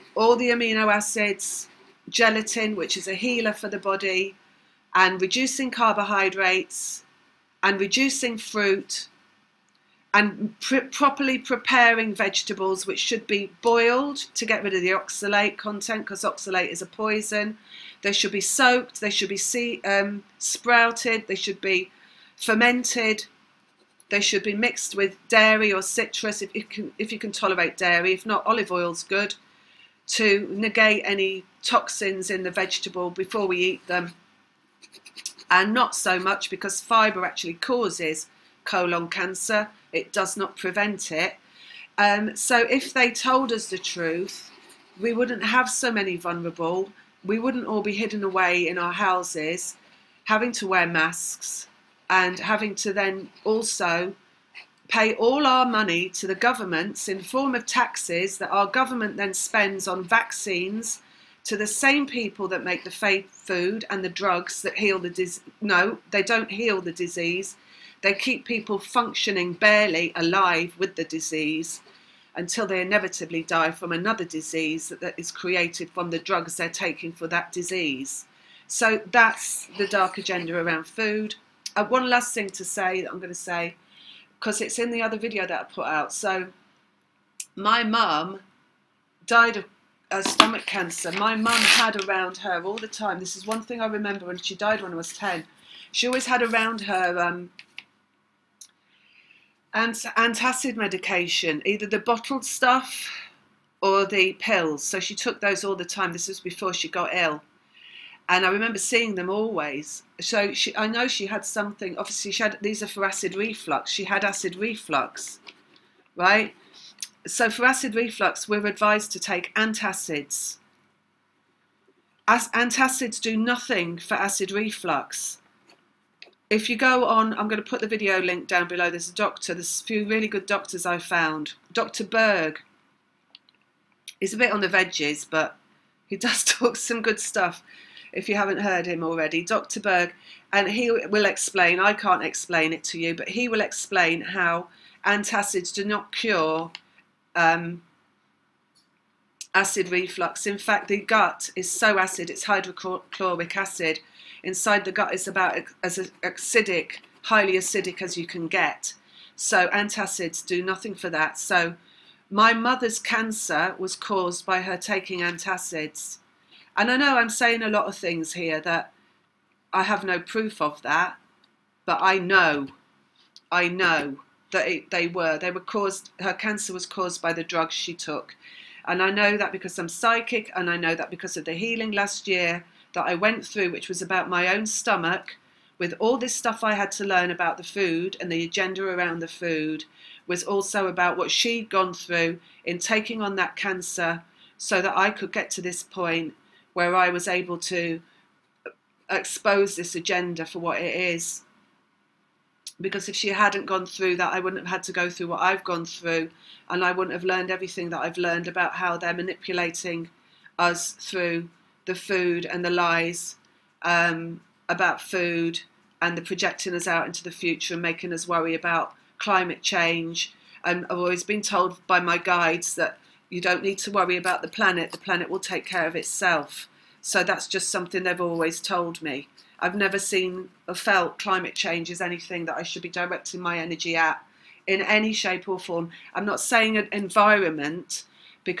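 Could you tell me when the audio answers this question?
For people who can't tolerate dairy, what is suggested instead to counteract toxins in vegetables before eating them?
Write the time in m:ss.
0:28.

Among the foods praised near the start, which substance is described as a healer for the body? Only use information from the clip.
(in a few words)
Gelatin.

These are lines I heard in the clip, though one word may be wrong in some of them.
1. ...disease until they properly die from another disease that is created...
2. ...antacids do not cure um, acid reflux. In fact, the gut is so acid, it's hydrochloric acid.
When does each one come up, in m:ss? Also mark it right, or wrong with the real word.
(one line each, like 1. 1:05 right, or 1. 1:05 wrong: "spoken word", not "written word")
1. 1:11 wrong: "inevitably", not "properly"
2. 2:25 right.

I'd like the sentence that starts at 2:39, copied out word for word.
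So antacids do nothing for that.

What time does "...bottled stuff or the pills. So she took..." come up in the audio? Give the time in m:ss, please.
1:41.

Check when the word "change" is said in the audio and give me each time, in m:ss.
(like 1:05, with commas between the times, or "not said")
3:39, 3:51.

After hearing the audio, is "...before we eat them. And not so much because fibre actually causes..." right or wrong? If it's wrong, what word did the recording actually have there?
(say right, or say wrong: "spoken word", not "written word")
right.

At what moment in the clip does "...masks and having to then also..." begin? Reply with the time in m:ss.
0:50.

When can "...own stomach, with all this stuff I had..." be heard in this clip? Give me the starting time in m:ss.
3:04.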